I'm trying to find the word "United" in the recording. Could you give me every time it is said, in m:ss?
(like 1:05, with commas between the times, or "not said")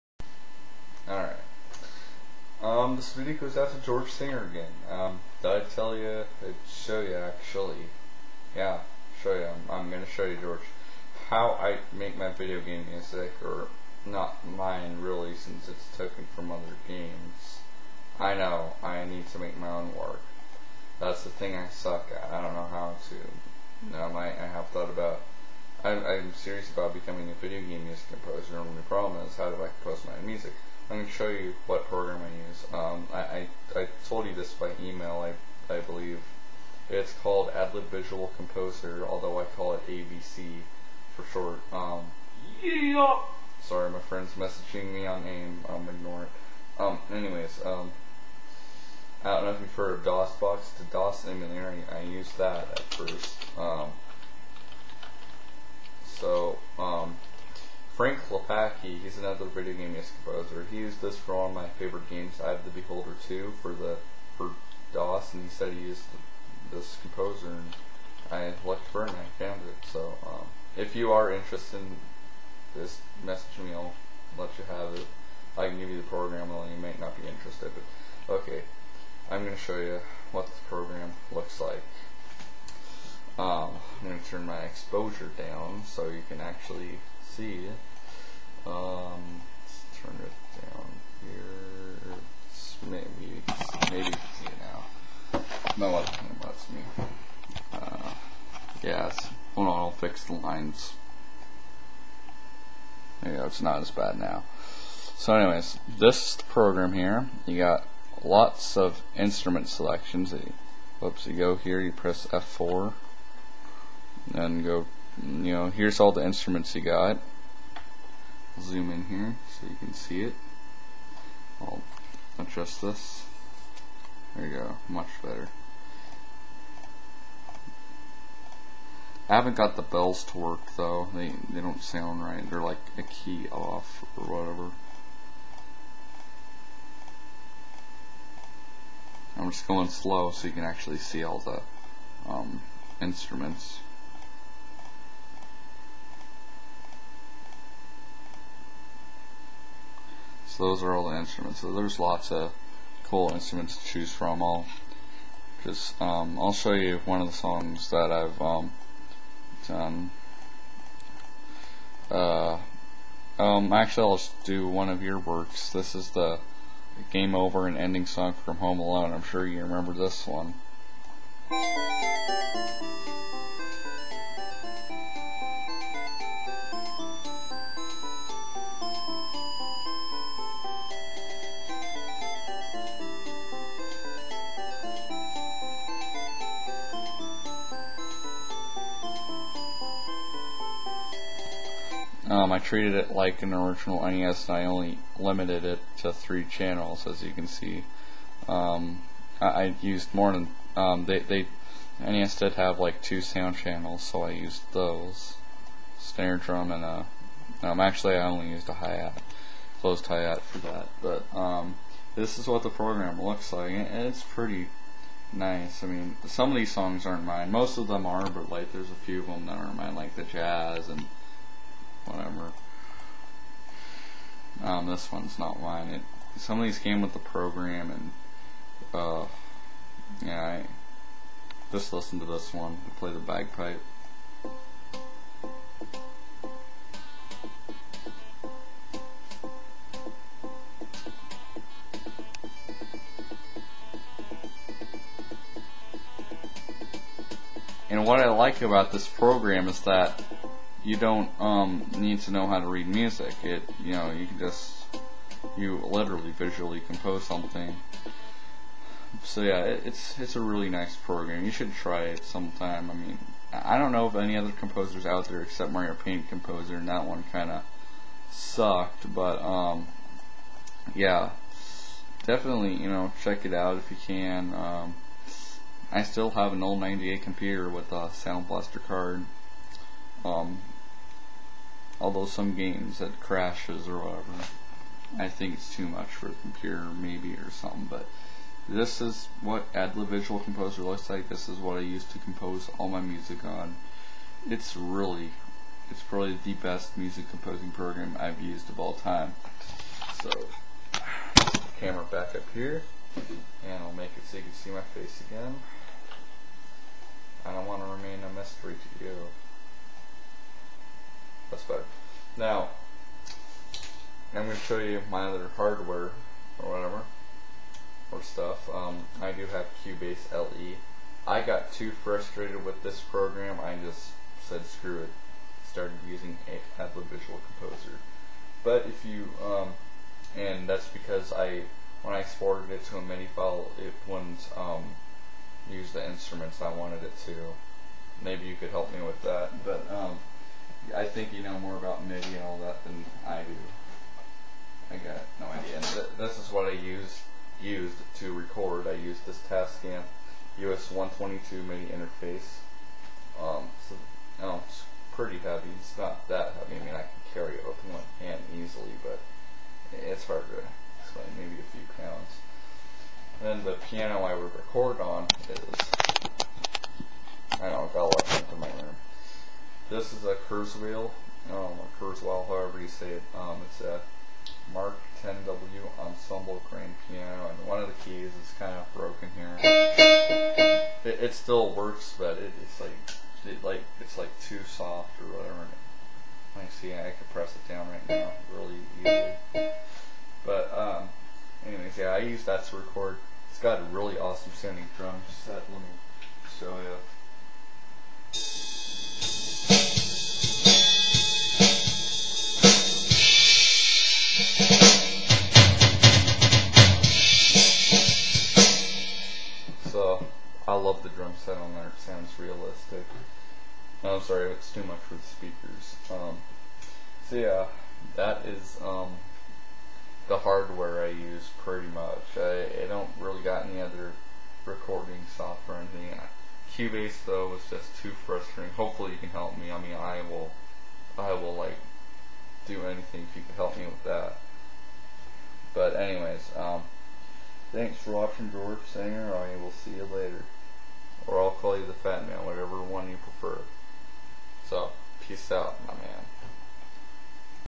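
not said.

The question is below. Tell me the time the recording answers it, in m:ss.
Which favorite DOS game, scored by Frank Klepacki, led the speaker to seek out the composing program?
1:02.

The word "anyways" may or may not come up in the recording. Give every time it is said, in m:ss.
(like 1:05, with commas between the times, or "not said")
0:47, 1:45, 6:31, 7:15.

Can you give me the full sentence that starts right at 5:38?
Maybe you could help me with that.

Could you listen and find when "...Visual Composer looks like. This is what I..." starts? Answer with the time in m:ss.
4:50.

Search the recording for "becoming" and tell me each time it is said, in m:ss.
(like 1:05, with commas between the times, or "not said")
0:26.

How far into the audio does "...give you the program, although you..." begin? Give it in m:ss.
1:15.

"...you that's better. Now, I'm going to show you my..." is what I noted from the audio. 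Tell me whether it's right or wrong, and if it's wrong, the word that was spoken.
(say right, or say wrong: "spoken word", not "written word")
right.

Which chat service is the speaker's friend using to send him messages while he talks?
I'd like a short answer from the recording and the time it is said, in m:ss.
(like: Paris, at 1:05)
AIM, at 0:45.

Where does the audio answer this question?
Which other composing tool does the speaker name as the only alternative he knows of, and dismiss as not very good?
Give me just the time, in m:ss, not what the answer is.
4:25.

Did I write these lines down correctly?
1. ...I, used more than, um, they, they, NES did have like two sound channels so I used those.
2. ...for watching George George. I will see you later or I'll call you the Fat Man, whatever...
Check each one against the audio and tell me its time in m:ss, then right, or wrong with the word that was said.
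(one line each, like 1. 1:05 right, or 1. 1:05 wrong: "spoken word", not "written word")
1. 3:19 right
2. 7:17 wrong: "Sanger", not "George".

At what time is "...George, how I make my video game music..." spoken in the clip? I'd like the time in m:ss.
0:10.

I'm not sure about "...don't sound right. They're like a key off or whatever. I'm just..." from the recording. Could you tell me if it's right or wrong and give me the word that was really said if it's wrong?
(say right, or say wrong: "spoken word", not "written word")
right.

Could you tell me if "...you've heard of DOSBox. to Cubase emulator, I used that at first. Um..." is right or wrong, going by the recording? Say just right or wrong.
wrong.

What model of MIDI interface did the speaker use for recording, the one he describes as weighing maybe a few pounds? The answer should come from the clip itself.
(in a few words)
Tascam US-122.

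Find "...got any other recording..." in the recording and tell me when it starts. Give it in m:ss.
7:03.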